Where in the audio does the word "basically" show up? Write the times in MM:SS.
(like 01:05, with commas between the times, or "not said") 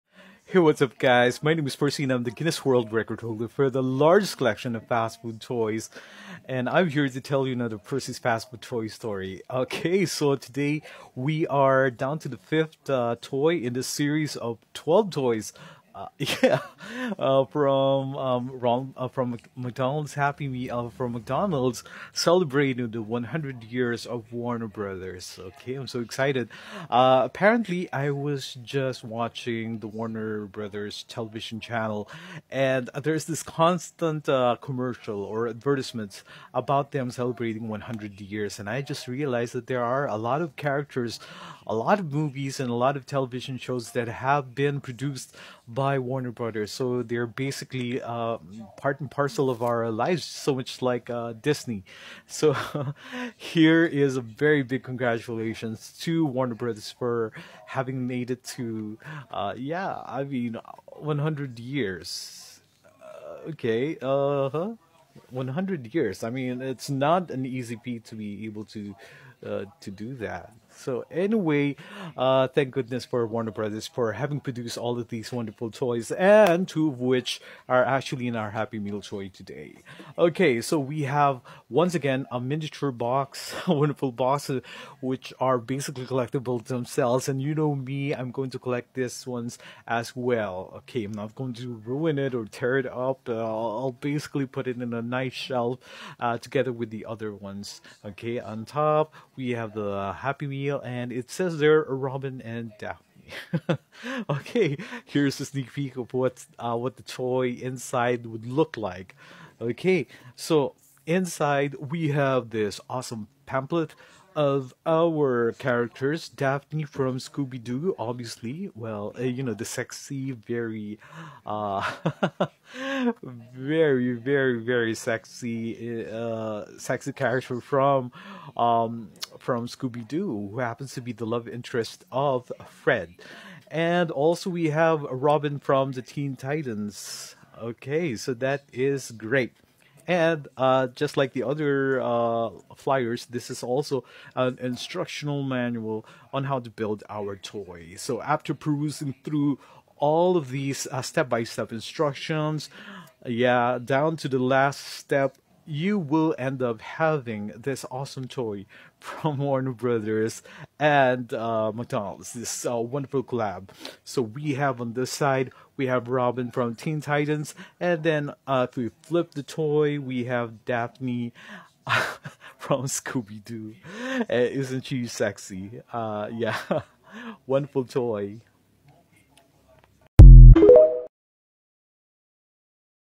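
00:47, 01:25, 01:33.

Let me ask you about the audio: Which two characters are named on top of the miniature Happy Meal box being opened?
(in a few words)
Robin and Daphne.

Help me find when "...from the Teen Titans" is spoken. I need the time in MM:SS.
02:15.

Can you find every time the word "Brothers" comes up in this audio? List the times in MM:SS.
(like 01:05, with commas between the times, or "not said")
00:24, 00:30, 00:46, 00:56, 01:13, 02:39.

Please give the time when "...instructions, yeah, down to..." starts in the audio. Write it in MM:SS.
02:31.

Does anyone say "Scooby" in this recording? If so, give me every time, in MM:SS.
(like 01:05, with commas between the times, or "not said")
01:57, 02:09, 02:52.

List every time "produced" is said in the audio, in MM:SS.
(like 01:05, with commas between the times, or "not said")
00:44, 01:14.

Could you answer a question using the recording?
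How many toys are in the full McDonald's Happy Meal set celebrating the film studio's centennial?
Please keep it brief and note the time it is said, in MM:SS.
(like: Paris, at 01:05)
12, at 00:14.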